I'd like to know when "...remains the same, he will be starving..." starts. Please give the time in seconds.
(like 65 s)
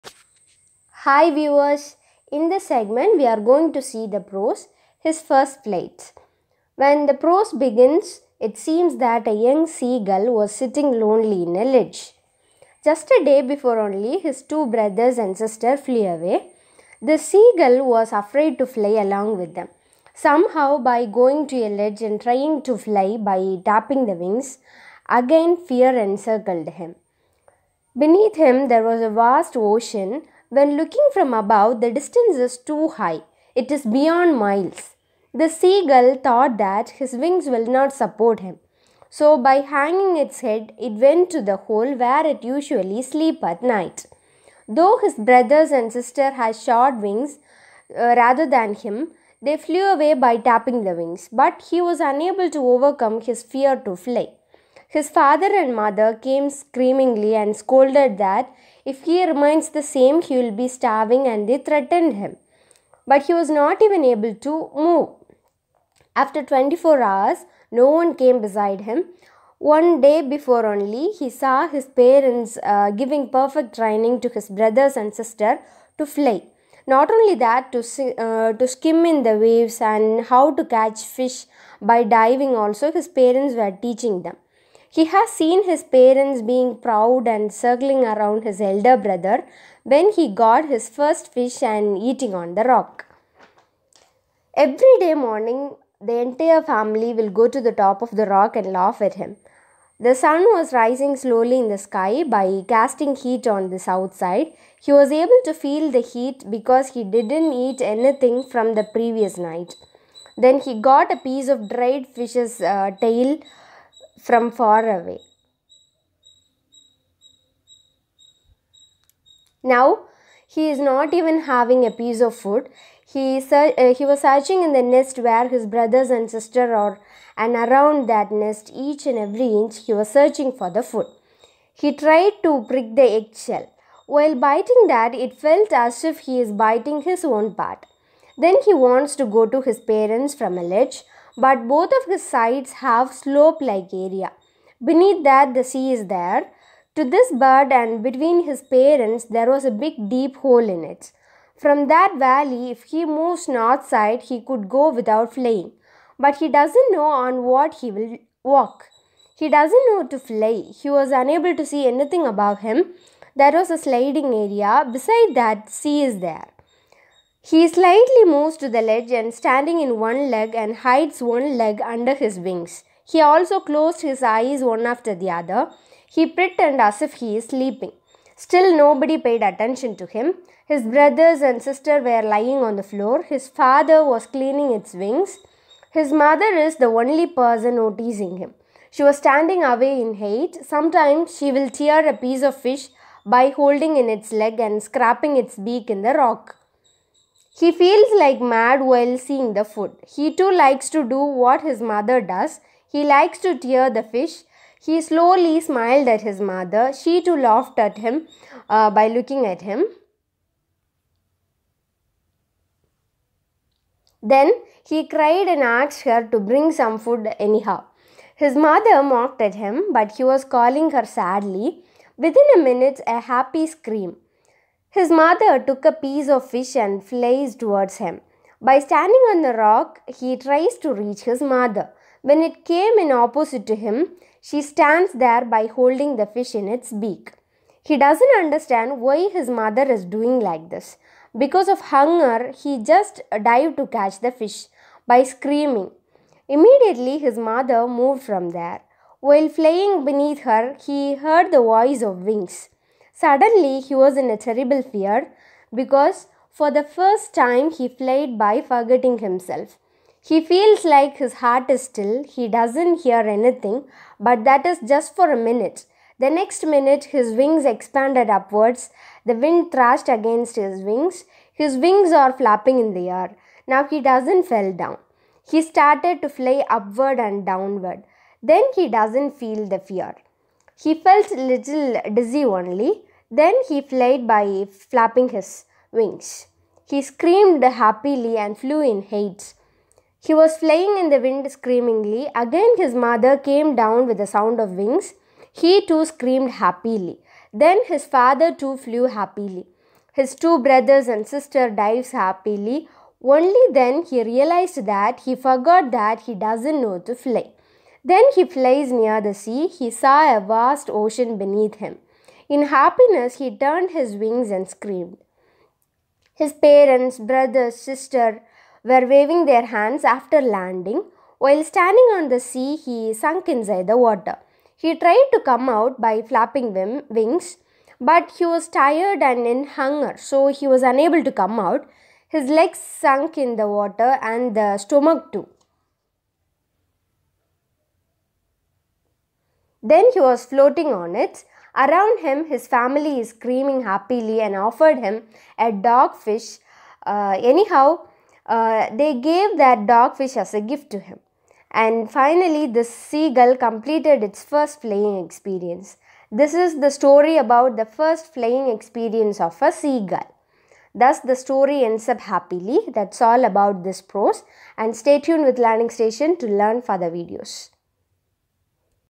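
59 s.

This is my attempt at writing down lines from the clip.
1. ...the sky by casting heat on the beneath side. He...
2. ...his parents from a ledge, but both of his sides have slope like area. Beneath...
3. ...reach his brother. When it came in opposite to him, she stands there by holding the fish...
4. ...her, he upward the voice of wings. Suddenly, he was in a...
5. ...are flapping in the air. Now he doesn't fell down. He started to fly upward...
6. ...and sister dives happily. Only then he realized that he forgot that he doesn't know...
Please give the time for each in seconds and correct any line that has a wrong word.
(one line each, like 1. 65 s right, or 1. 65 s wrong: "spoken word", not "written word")
1. 101 s wrong: "south", not "beneath"
2. 139 s right
3. 230 s wrong: "mother", not "brother"
4. 250 s wrong: "heard", not "upward"
5. 272 s right
6. 301 s right.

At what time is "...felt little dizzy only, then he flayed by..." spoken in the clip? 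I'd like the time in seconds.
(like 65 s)
280 s.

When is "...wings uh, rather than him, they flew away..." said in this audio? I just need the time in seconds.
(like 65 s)
46 s.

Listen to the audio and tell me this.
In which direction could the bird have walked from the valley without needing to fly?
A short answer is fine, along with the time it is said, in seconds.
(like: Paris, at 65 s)
north, at 153 s.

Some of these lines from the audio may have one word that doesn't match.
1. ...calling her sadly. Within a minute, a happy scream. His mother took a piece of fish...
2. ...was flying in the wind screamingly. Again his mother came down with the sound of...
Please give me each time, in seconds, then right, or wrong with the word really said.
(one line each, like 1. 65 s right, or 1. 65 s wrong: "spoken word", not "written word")
1. 220 s right
2. 290 s right.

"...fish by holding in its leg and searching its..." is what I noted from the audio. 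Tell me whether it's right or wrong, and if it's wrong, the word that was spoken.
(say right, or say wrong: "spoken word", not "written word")
wrong: "scraping", not "searching".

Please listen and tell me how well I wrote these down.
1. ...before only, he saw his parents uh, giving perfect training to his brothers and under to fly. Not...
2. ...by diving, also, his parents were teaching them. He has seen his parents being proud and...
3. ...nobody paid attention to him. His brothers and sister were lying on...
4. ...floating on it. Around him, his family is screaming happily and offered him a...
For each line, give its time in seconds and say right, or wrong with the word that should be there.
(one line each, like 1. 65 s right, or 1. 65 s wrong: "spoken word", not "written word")
1. 70 s wrong: "sister", not "under"
2. 81 s right
3. 178 s right
4. 340 s right.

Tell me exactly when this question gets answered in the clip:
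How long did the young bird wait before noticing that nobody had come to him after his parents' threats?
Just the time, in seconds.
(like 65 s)
66 s.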